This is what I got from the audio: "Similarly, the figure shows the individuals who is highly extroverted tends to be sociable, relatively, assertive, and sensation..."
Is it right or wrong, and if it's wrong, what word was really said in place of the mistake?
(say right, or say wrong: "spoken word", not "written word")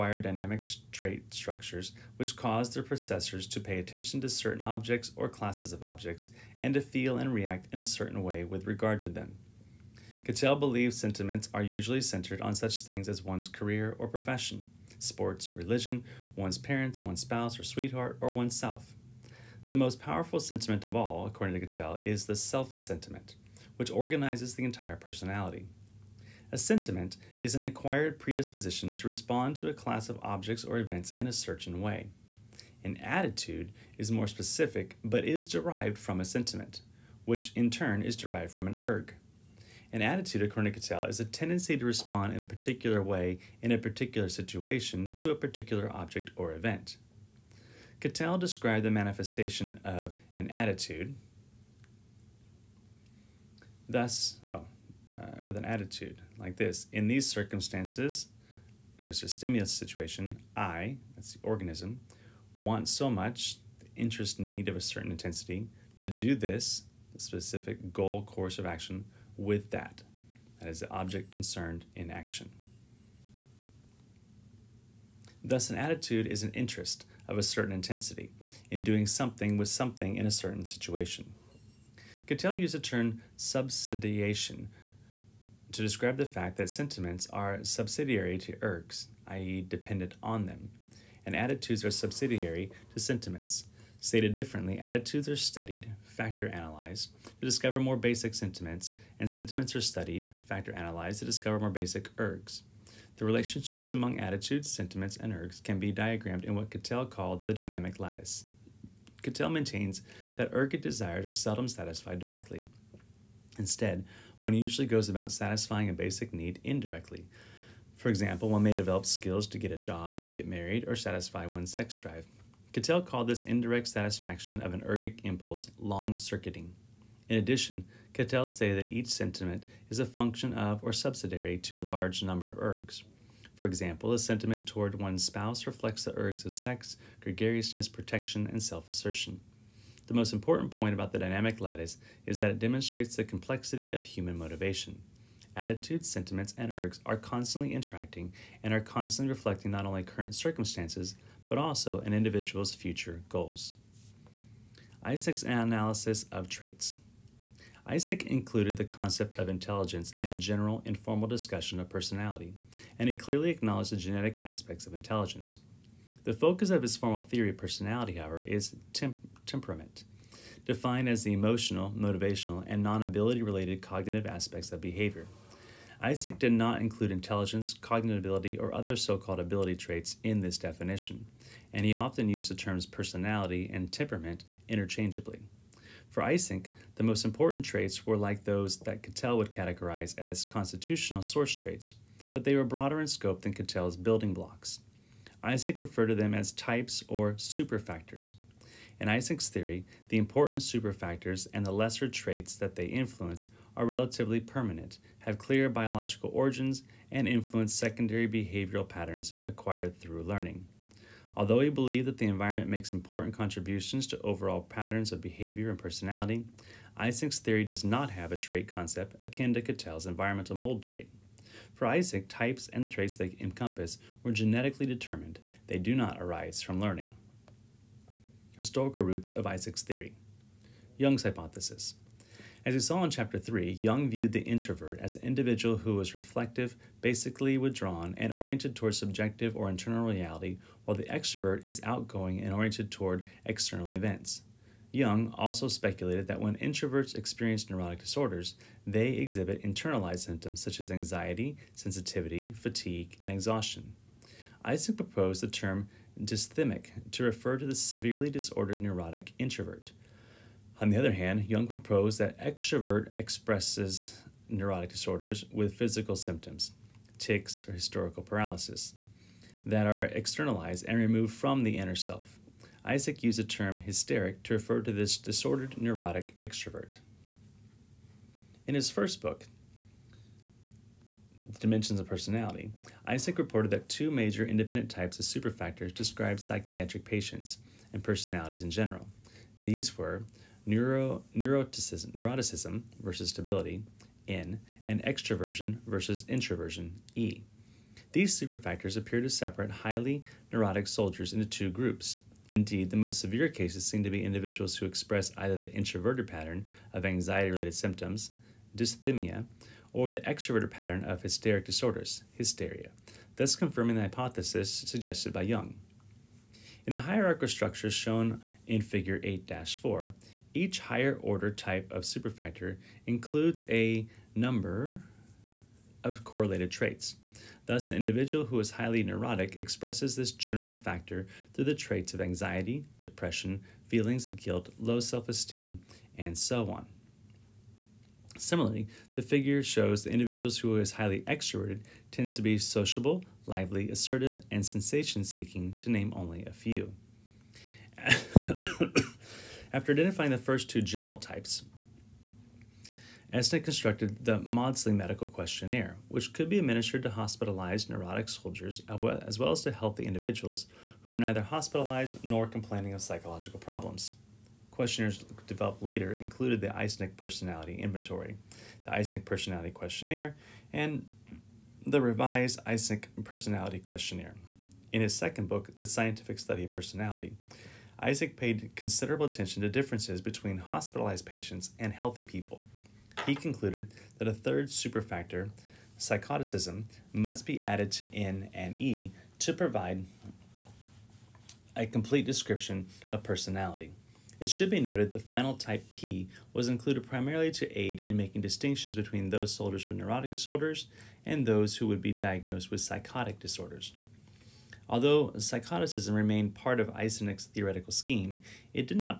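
wrong: "lively", not "relatively".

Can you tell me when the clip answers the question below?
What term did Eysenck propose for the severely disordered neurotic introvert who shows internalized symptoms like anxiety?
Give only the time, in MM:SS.
04:16.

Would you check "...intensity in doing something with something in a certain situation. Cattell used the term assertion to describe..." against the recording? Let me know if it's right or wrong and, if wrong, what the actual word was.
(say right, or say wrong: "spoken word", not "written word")
wrong: "subsidiation", not "assertion".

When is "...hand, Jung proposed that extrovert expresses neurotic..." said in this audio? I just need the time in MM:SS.
04:21.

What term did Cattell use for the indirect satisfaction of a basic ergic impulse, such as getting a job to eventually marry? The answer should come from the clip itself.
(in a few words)
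long circuiting.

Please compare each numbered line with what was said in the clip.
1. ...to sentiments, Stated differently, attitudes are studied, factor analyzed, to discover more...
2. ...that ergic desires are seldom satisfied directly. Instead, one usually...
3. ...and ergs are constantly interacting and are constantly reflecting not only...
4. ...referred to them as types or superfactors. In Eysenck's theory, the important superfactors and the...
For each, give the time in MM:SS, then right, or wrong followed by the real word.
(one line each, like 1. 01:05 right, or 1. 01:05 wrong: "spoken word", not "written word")
1. 01:32 right
2. 01:50 right
3. 02:26 right
4. 03:15 right.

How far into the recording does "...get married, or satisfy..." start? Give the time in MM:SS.
02:00.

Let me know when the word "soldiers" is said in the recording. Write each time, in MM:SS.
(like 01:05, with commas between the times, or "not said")
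05:00, 05:58, 06:39.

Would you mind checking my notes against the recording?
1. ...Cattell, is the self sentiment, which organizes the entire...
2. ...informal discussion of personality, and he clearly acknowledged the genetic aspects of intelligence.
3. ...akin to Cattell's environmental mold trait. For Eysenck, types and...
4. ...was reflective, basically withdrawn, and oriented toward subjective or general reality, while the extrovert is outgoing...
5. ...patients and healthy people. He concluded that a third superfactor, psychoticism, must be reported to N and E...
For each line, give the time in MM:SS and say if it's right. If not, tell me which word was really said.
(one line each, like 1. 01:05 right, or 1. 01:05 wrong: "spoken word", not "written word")
1. 00:21 right
2. 02:40 right
3. 03:39 right
4. 03:55 wrong: "internal", not "general"
5. 06:21 wrong: "added", not "reported".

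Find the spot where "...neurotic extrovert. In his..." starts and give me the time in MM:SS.
04:35.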